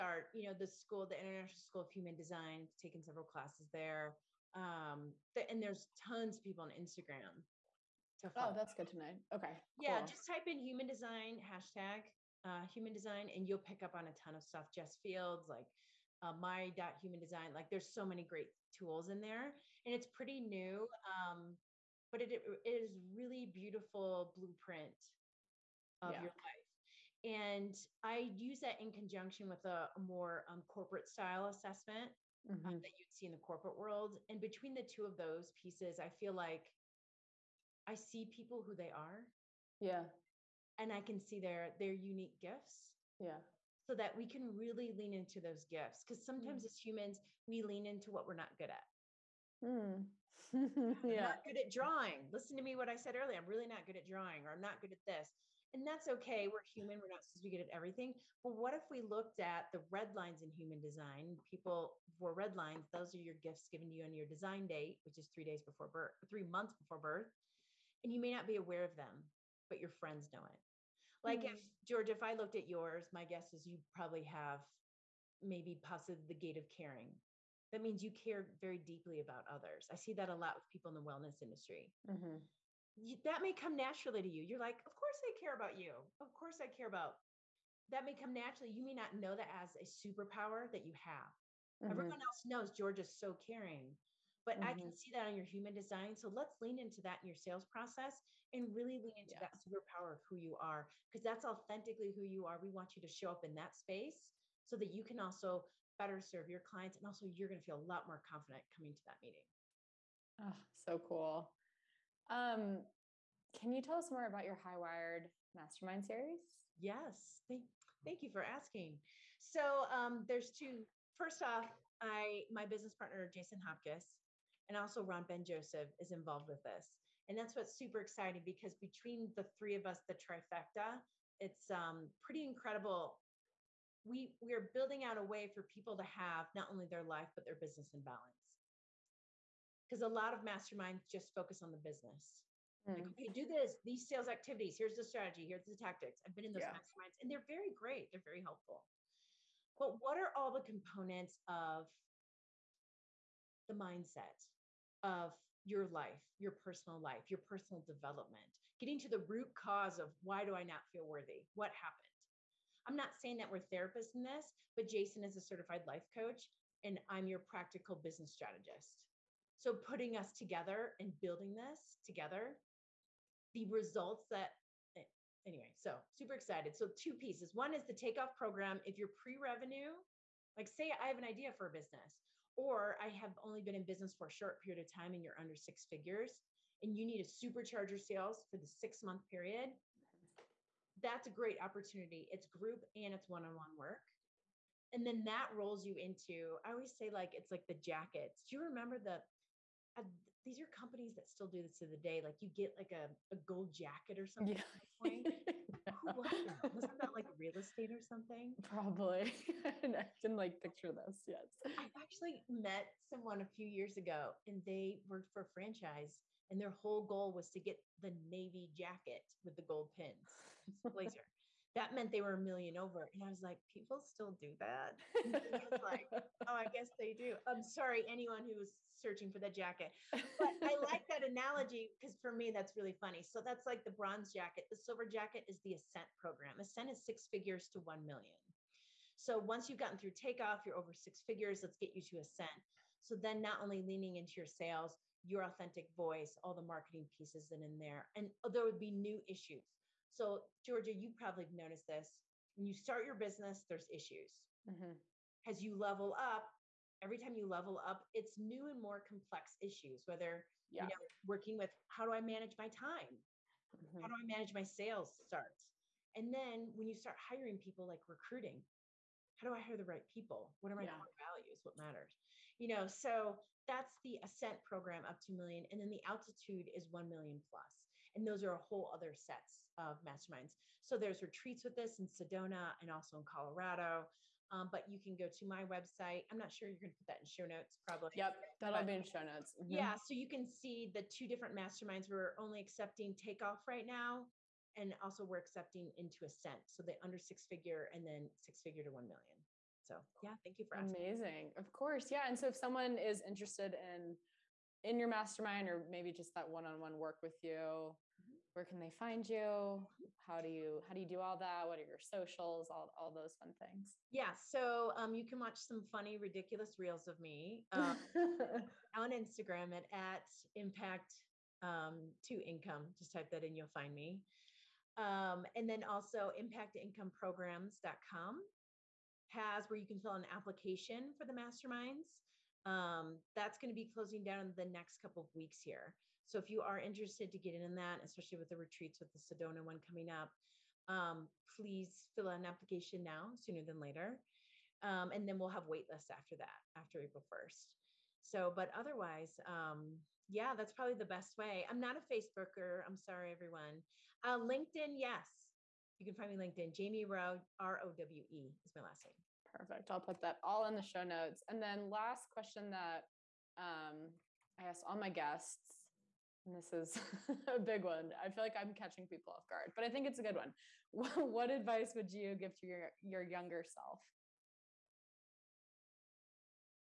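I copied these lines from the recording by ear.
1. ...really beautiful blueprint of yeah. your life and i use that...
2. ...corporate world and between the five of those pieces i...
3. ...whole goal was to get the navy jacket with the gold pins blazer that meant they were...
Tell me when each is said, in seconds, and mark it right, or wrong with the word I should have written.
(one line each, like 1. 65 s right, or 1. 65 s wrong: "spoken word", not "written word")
1. 22 s right
2. 33 s wrong: "two", not "five"
3. 216 s right.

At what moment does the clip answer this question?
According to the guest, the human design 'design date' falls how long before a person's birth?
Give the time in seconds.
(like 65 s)
66 s.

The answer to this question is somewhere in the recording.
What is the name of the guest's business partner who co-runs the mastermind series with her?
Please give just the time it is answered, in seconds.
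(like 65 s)
123 s.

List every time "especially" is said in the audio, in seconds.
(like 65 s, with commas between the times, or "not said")
338 s.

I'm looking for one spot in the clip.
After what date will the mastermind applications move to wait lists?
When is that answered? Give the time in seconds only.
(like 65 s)
346 s.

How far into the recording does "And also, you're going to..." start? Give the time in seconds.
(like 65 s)
106 s.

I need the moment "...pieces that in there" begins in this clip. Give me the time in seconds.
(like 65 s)
247 s.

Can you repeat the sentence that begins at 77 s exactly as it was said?
That means you care very deeply about others.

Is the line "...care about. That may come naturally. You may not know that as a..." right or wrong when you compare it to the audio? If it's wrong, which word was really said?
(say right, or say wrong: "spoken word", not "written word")
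right.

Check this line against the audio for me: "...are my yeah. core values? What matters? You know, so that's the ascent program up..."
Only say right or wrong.
right.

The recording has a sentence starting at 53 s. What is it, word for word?
I'm really not good at drawing or I'm not good at this.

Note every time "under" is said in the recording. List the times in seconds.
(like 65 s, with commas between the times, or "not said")
185 s, 297 s.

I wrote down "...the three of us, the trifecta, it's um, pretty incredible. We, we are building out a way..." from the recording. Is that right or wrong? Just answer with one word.
right.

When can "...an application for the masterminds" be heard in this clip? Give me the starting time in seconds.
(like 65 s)
330 s.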